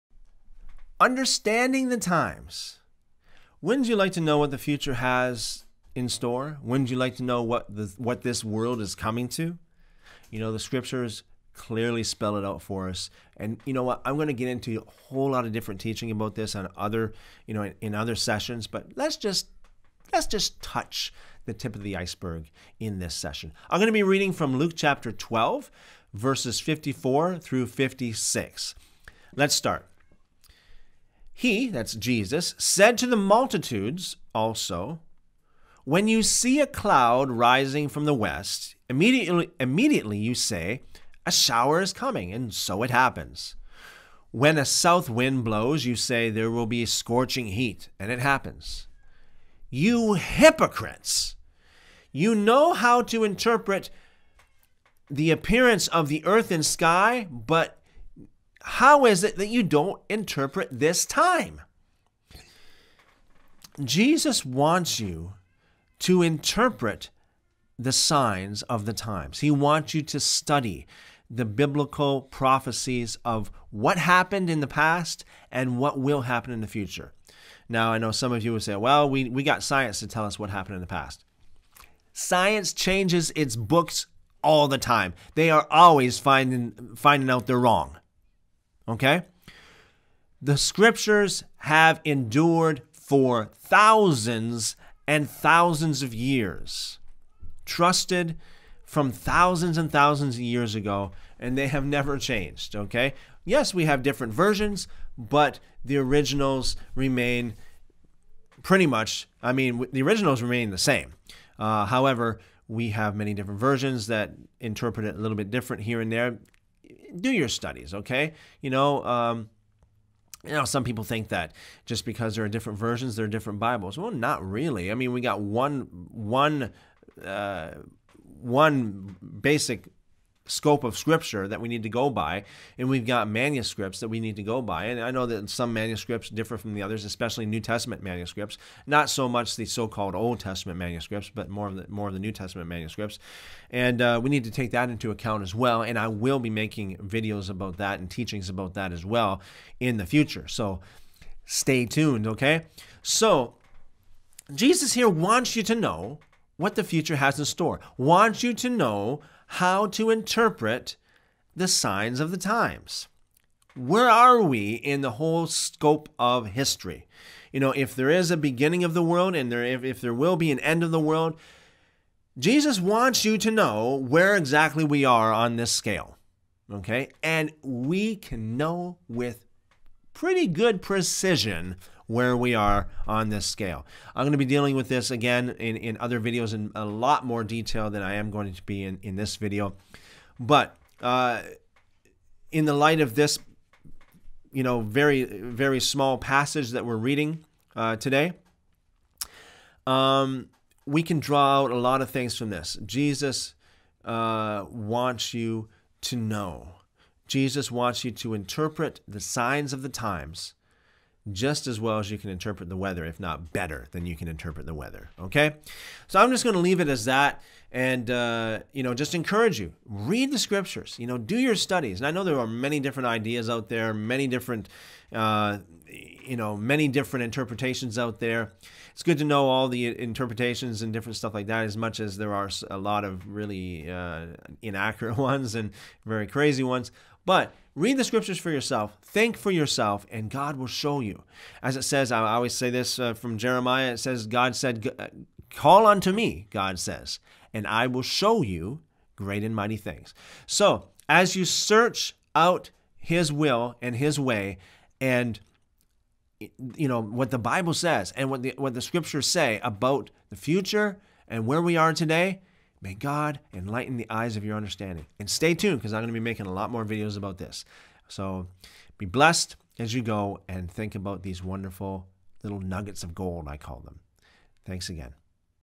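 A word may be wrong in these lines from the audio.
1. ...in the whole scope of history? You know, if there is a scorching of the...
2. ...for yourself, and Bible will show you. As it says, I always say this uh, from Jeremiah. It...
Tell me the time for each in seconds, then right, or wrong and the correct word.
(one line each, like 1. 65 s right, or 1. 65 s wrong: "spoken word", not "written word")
1. 164 s wrong: "beginning", not "scorching"
2. 239 s wrong: "God", not "Bible".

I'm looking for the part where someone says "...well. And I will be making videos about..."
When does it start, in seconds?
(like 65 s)
145 s.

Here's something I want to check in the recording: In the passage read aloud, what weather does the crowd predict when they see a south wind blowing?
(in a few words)
scorching heat.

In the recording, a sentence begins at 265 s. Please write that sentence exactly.
And stay tuned because I'm going to be making a lot more videos about this.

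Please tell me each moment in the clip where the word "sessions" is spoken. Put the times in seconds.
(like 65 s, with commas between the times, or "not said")
18 s, 23 s.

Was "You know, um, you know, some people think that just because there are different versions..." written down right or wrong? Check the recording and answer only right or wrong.
right.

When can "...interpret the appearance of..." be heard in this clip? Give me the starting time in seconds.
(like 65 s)
53 s.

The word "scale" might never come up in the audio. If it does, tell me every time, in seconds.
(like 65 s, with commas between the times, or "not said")
175 s, 183 s.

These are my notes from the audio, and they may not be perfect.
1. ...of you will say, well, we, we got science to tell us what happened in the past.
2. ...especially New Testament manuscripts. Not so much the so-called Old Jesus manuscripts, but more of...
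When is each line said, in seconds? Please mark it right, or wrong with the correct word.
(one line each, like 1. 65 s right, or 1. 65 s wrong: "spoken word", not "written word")
1. 78 s right
2. 137 s wrong: "Testament", not "Jesus".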